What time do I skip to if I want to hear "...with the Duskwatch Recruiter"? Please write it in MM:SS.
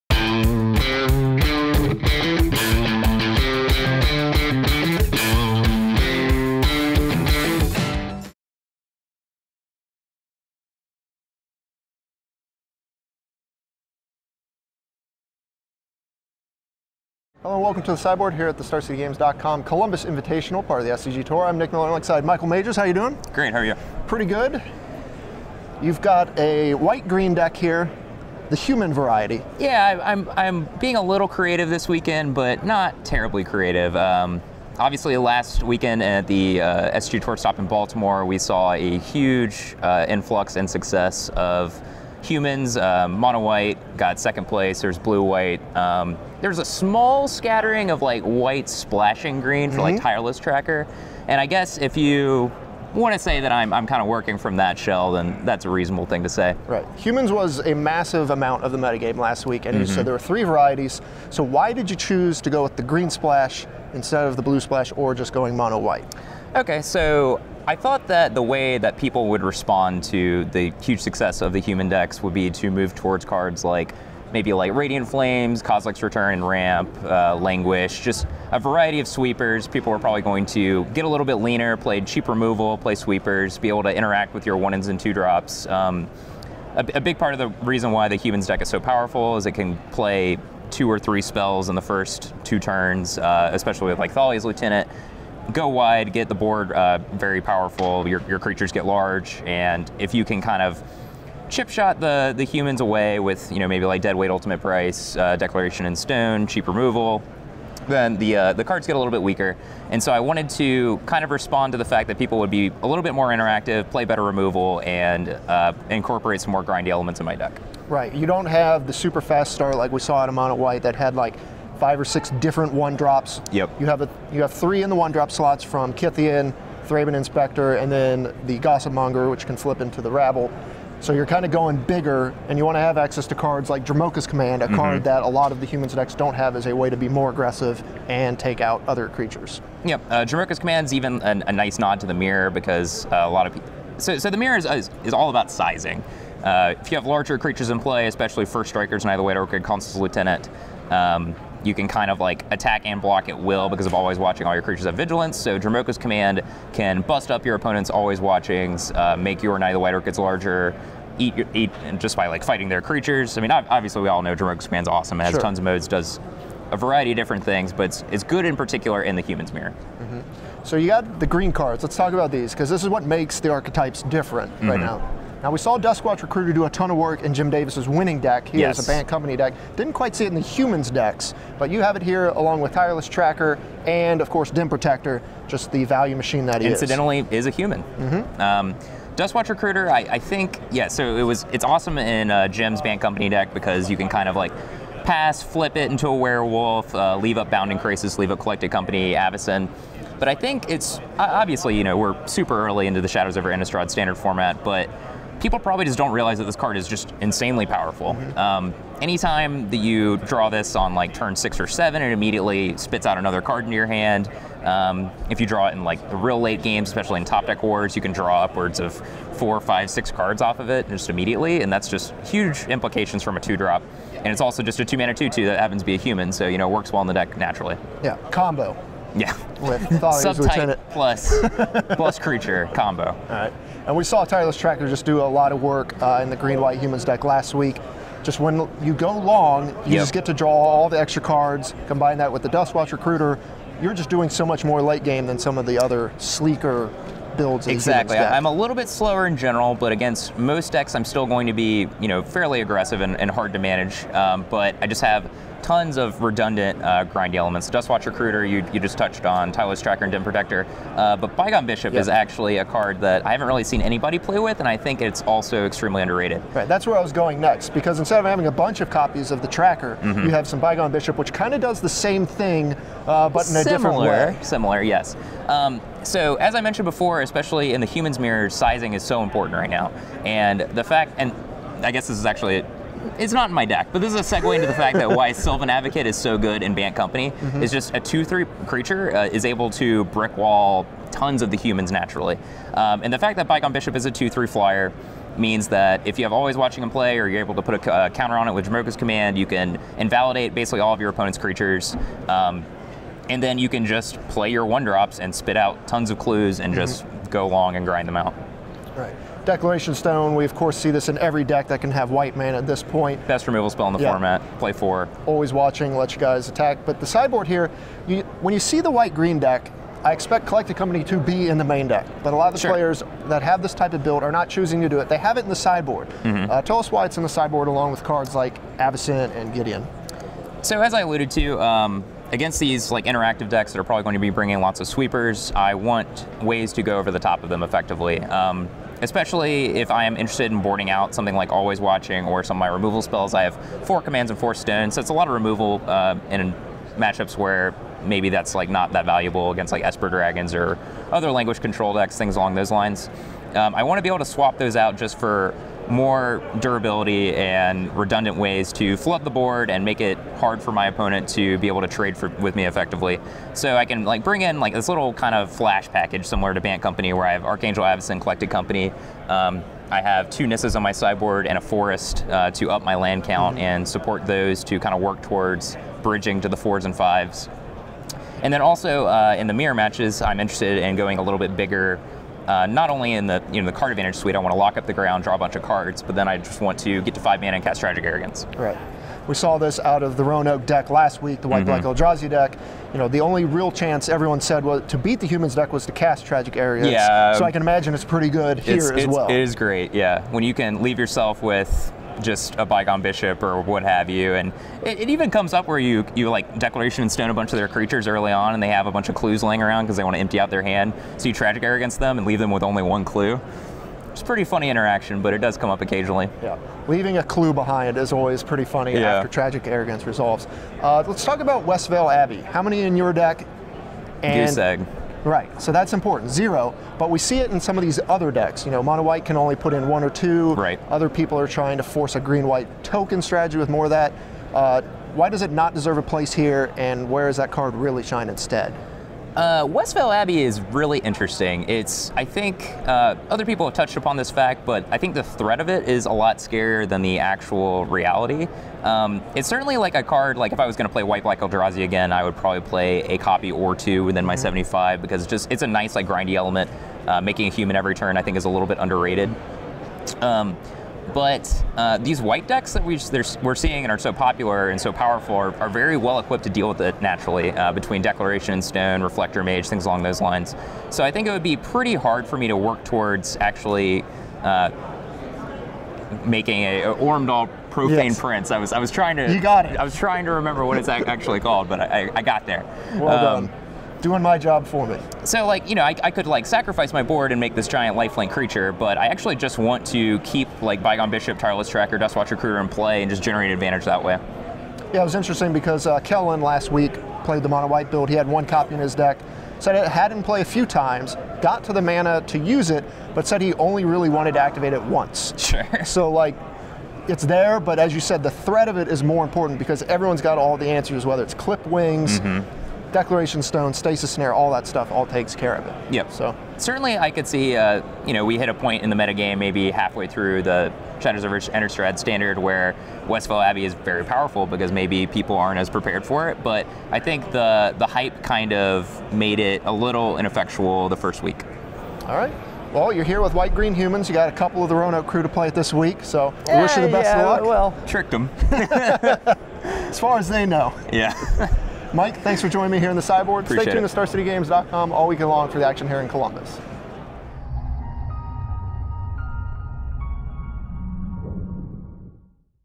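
04:02.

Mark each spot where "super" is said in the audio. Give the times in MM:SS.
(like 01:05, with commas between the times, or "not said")
01:58, 03:22.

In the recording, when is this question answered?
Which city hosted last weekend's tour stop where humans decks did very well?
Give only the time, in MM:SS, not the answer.
00:37.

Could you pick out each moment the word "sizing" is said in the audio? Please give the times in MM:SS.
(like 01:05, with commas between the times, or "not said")
02:25, 04:38.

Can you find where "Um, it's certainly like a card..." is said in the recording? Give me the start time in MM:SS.
07:28.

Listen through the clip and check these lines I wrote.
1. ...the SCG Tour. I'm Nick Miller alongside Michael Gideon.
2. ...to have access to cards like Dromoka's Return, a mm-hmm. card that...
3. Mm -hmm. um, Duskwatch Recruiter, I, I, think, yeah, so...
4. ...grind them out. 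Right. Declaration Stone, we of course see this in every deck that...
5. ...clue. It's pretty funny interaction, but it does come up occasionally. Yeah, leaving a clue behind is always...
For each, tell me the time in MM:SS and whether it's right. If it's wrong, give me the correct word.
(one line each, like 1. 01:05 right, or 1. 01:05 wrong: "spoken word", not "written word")
1. 00:20 wrong: "Majors", not "Gideon"
2. 02:12 wrong: "Command", not "Return"
3. 03:07 right
4. 05:07 right
5. 06:53 right.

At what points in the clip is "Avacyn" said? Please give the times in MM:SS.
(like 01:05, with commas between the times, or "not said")
03:19, 05:28, 06:07.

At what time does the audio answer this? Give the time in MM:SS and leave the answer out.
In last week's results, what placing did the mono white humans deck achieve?
00:44.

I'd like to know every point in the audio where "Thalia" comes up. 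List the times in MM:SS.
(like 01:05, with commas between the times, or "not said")
01:34, 03:49.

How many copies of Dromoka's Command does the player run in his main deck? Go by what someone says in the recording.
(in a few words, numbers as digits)
4.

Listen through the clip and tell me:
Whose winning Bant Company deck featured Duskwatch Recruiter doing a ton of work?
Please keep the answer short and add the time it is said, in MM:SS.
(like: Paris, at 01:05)
Jim Davis, at 02:57.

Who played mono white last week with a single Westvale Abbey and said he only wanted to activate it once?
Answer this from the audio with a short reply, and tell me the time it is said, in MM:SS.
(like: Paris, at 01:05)
Kellen, at 08:16.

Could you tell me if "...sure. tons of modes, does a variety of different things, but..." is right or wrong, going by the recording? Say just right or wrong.
right.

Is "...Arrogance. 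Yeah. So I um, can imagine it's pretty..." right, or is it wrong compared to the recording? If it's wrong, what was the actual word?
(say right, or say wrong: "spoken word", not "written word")
right.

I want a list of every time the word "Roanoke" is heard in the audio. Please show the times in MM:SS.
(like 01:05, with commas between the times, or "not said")
06:30, 08:54.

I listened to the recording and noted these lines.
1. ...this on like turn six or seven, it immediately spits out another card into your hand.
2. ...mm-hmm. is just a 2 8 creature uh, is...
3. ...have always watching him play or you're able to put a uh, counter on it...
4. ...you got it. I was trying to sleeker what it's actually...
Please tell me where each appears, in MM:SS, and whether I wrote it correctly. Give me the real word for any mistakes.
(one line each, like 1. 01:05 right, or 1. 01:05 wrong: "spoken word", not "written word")
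1. 03:30 right
2. 04:47 wrong: "3", not "8"
3. 04:56 right
4. 07:59 wrong: "remember", not "sleeker".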